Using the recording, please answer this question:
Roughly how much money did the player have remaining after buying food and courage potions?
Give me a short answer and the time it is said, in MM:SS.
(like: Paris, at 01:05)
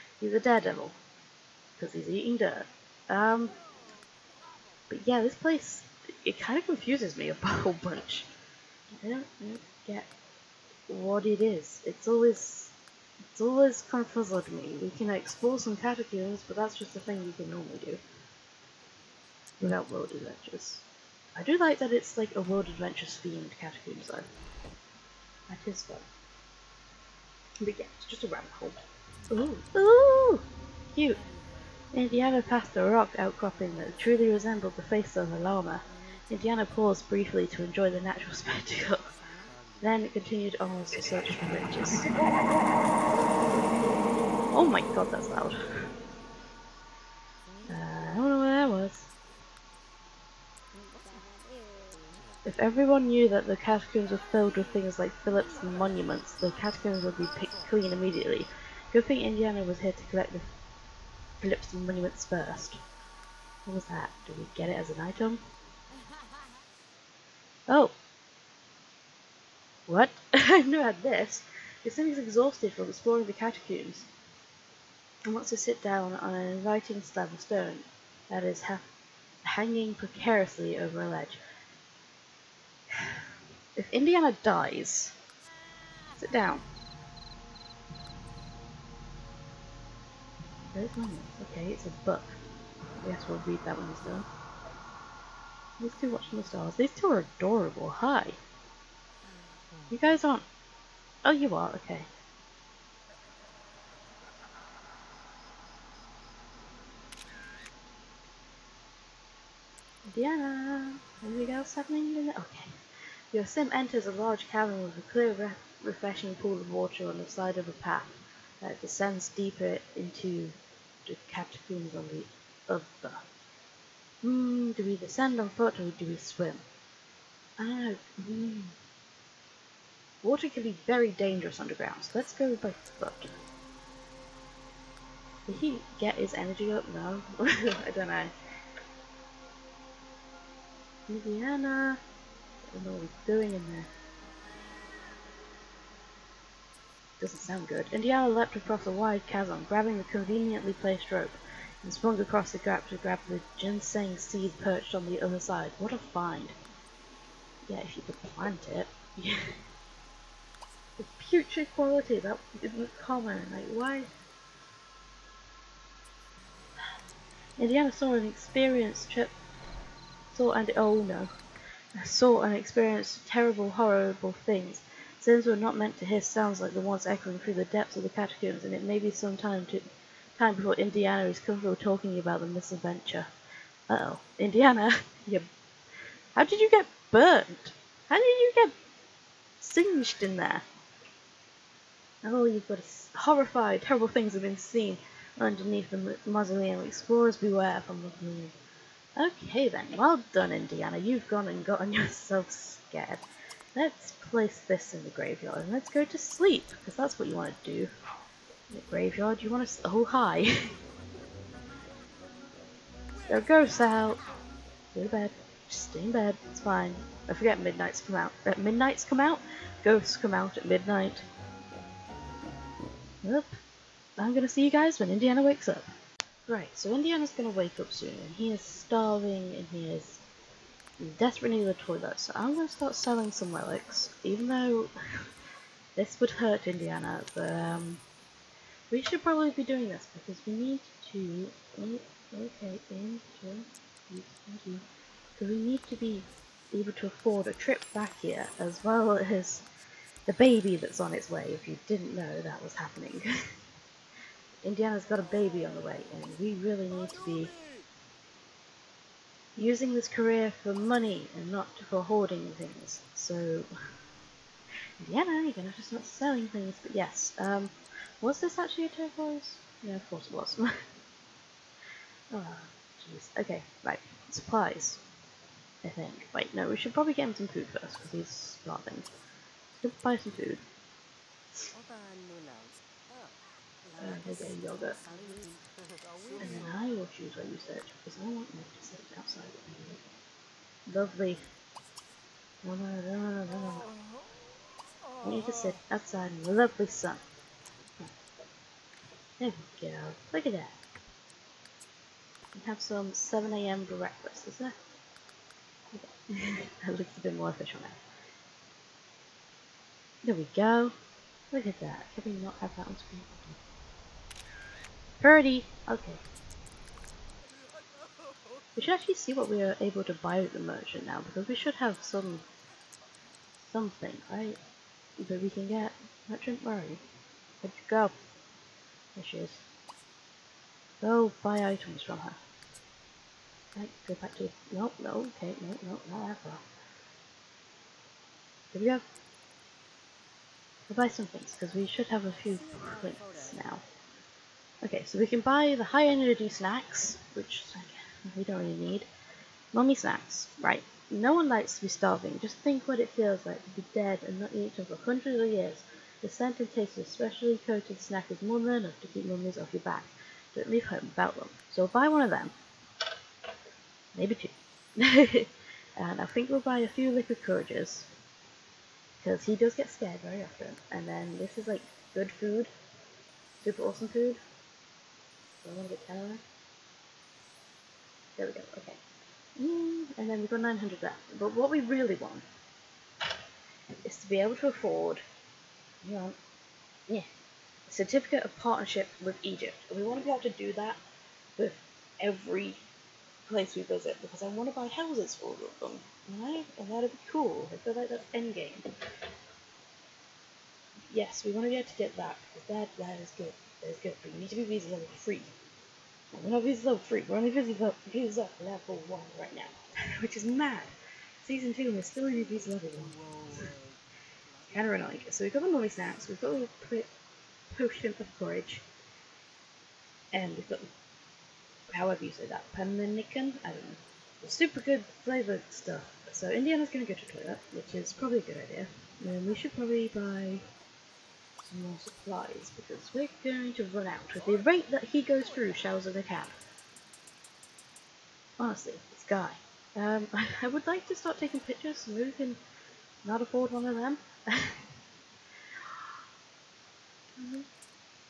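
900, at 06:20.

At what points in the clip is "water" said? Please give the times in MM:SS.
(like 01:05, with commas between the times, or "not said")
01:56, 02:10.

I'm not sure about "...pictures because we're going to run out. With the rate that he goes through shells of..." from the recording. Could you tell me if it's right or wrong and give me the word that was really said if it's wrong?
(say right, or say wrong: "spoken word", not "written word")
wrong: "supplies", not "pictures".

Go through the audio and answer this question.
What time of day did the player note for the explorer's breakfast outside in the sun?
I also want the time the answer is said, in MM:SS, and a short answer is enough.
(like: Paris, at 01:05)
7 a.m., at 05:03.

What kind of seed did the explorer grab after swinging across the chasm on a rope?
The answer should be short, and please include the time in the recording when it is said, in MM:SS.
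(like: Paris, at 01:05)
Ginseng seed, at 02:33.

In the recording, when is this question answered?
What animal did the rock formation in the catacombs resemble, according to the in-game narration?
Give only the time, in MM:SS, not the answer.
00:35.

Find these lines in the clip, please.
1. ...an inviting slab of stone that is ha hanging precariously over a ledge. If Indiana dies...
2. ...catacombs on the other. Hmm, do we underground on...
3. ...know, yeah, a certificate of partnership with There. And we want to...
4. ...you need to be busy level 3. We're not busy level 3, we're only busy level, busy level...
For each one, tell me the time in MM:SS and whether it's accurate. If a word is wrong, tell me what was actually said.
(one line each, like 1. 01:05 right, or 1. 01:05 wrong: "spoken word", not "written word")
1. 01:16 right
2. 02:01 wrong: "descend", not "underground"
3. 06:26 wrong: "Egypt", not "There"
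4. 06:44 right.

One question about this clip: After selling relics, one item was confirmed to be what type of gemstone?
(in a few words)
Turquoise.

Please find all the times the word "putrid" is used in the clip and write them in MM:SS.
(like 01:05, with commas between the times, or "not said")
02:41.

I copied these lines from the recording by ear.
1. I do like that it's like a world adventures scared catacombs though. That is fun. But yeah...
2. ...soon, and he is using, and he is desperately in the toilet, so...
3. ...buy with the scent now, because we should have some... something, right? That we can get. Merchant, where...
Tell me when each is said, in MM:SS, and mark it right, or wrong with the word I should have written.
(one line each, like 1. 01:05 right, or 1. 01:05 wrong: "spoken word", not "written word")
1. 00:21 wrong: "themed", not "scared"
2. 03:47 wrong: "starving", not "using"
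3. 05:20 wrong: "merchant", not "scent".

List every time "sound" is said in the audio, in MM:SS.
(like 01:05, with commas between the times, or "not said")
02:27, 02:56.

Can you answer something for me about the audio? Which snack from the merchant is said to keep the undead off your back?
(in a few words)
Mummy snacks.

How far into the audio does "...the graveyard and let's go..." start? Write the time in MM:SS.
03:25.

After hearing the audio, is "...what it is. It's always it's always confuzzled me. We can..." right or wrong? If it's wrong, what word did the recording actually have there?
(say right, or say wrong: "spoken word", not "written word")
right.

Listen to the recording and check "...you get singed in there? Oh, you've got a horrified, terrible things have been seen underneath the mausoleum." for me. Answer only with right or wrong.
right.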